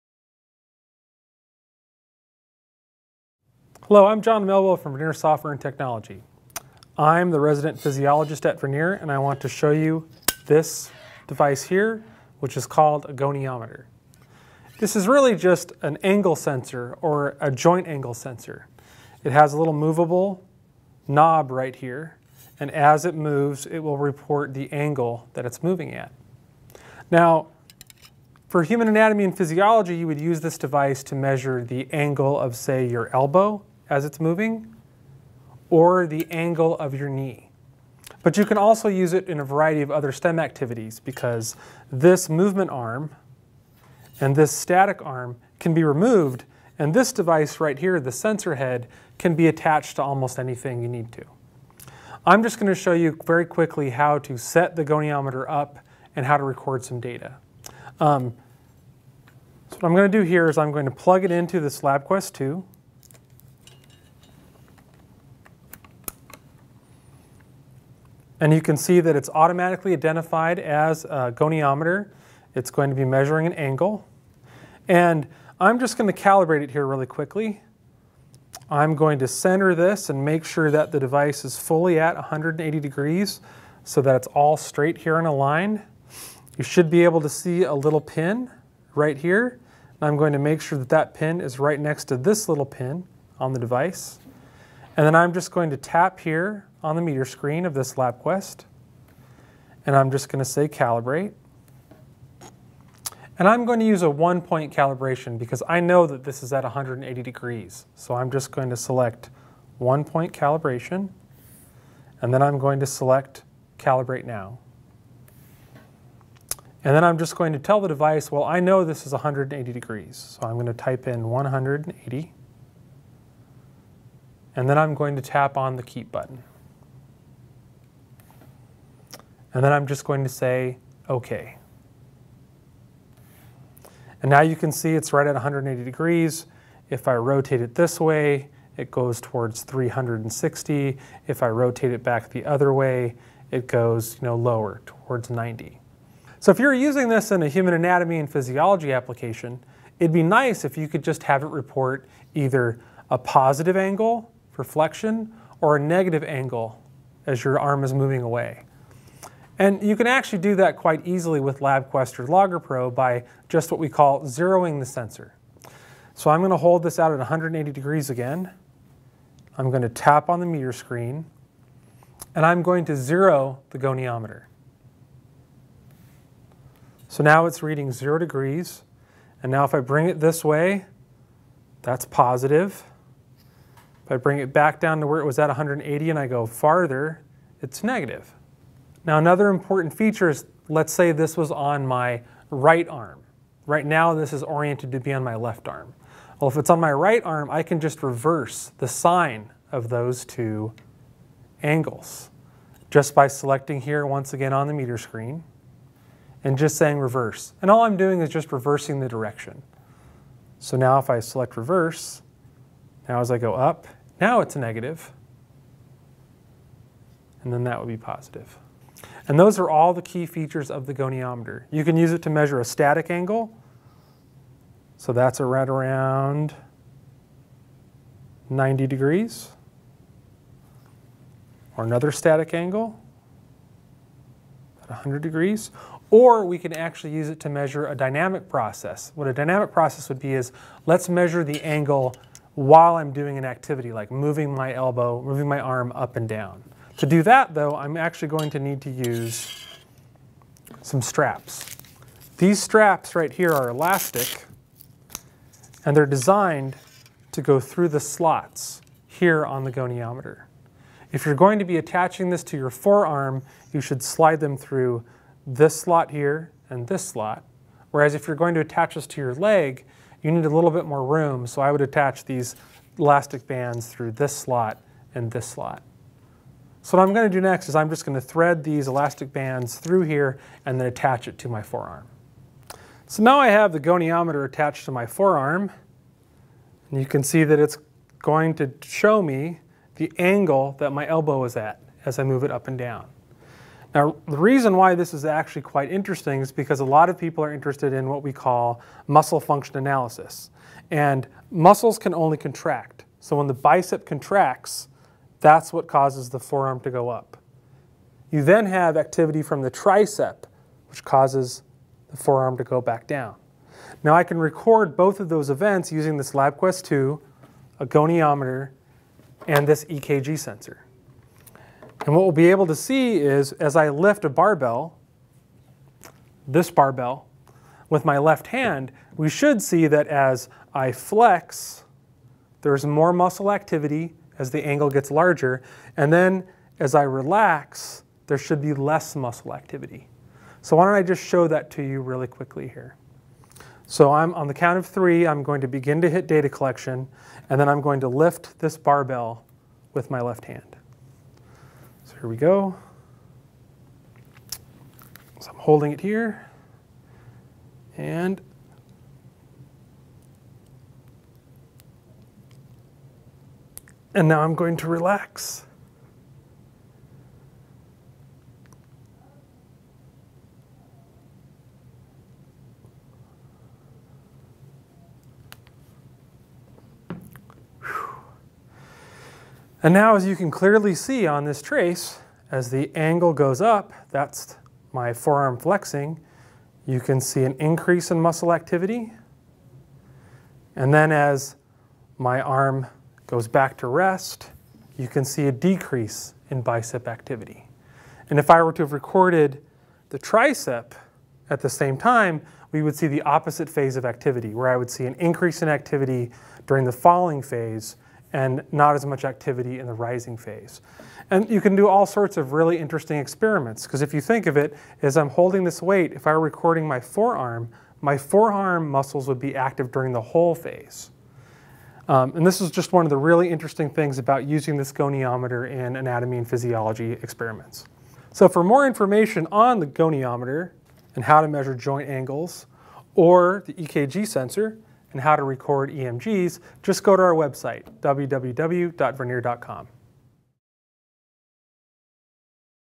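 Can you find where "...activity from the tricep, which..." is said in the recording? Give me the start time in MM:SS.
05:08.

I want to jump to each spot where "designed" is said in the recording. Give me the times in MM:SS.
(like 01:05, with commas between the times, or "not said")
04:16.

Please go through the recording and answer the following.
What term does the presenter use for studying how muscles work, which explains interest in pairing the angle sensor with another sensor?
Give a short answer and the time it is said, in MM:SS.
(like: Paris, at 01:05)
Muscle function analysis, at 04:59.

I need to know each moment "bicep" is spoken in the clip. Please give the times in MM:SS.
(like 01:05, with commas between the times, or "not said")
05:03, 06:36.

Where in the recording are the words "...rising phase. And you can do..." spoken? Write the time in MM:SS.
06:49.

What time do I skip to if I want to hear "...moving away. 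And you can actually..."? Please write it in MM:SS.
02:37.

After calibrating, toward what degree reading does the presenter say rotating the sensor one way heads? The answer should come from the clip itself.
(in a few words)
360.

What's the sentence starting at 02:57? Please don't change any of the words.
So now it's reading zero degrees, and now if I bring it this way, that's positive.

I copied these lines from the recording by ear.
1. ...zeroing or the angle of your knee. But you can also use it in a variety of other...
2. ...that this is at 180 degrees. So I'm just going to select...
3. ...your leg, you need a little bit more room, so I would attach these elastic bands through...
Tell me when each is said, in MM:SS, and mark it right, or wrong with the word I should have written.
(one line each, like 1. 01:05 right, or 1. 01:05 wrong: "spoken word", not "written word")
1. 00:34 wrong: "moving", not "zeroing"
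2. 01:46 right
3. 04:29 right.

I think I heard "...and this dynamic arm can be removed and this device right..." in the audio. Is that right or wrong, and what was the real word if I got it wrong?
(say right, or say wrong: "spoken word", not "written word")
wrong: "static", not "dynamic".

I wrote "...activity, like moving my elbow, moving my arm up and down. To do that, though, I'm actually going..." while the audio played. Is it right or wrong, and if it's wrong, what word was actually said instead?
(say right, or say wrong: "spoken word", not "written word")
right.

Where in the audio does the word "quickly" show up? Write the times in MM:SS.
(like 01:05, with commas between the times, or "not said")
00:53, 01:17, 05:42.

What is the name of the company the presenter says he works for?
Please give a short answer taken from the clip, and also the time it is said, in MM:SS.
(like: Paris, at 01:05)
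Vernier Software and Technology, at 00:04.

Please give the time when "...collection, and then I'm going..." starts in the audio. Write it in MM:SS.
05:46.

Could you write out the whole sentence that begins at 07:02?
Um, and this is just one of the really interesting things about using this goniometer in anatomy and physiology experiments.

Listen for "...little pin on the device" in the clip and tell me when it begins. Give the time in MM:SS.
01:32.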